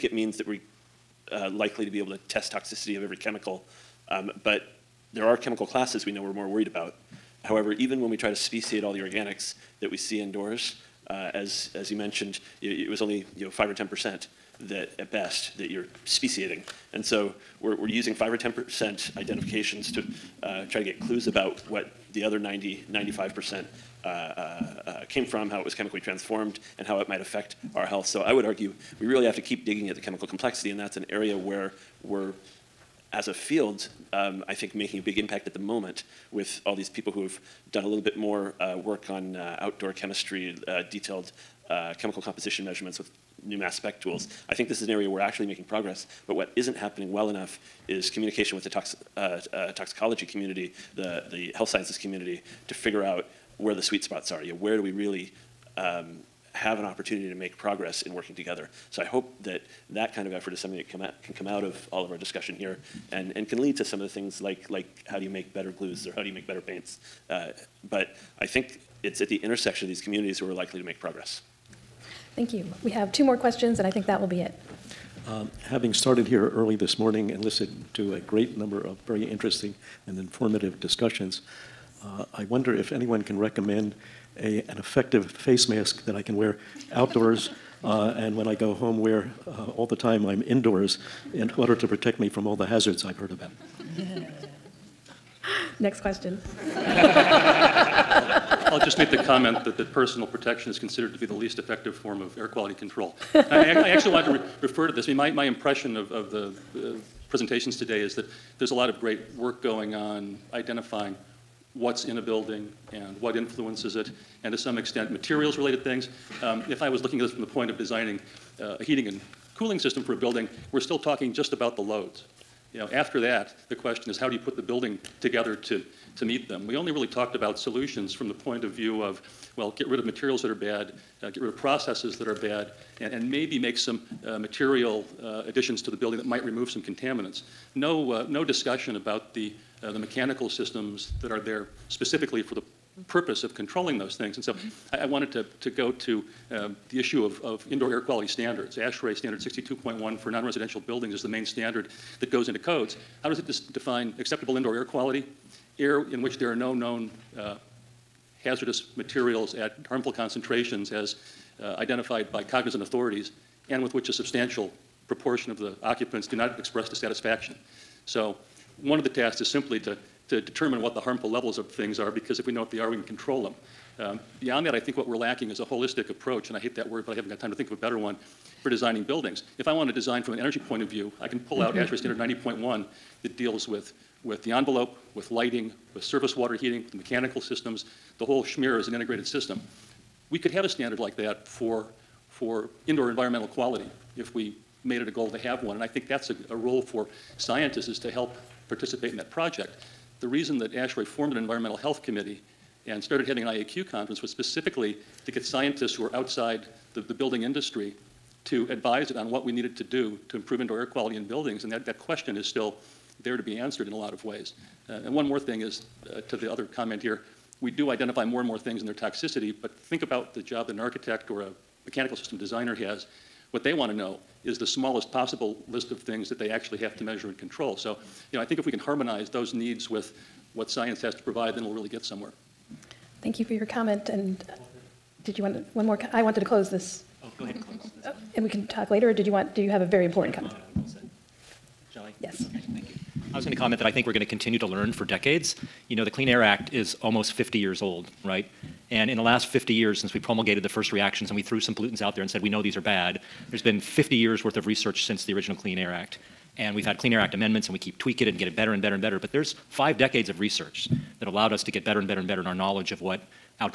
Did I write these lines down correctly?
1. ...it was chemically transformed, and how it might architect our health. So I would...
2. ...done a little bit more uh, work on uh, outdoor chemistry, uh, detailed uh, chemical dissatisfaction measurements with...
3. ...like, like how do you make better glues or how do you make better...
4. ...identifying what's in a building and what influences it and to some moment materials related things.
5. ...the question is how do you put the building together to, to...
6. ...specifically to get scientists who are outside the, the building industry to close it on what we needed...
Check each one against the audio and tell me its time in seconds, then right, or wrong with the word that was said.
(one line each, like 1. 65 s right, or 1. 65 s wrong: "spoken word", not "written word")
1. 25 s wrong: "affect", not "architect"
2. 37 s wrong: "composition", not "dissatisfaction"
3. 64 s right
4. 110 s wrong: "extent", not "moment"
5. 123 s right
6. 204 s wrong: "advise", not "close".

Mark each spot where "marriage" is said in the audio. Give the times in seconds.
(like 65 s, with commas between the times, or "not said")
not said.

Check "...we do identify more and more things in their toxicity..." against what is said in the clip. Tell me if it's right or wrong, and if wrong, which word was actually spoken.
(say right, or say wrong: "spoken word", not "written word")
right.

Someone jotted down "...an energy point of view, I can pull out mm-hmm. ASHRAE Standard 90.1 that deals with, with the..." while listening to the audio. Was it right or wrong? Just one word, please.
right.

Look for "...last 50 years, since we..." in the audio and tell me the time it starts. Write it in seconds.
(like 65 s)
249 s.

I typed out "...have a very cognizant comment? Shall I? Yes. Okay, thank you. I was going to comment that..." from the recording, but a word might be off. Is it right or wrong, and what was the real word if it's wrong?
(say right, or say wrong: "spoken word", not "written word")
wrong: "important", not "cognizant".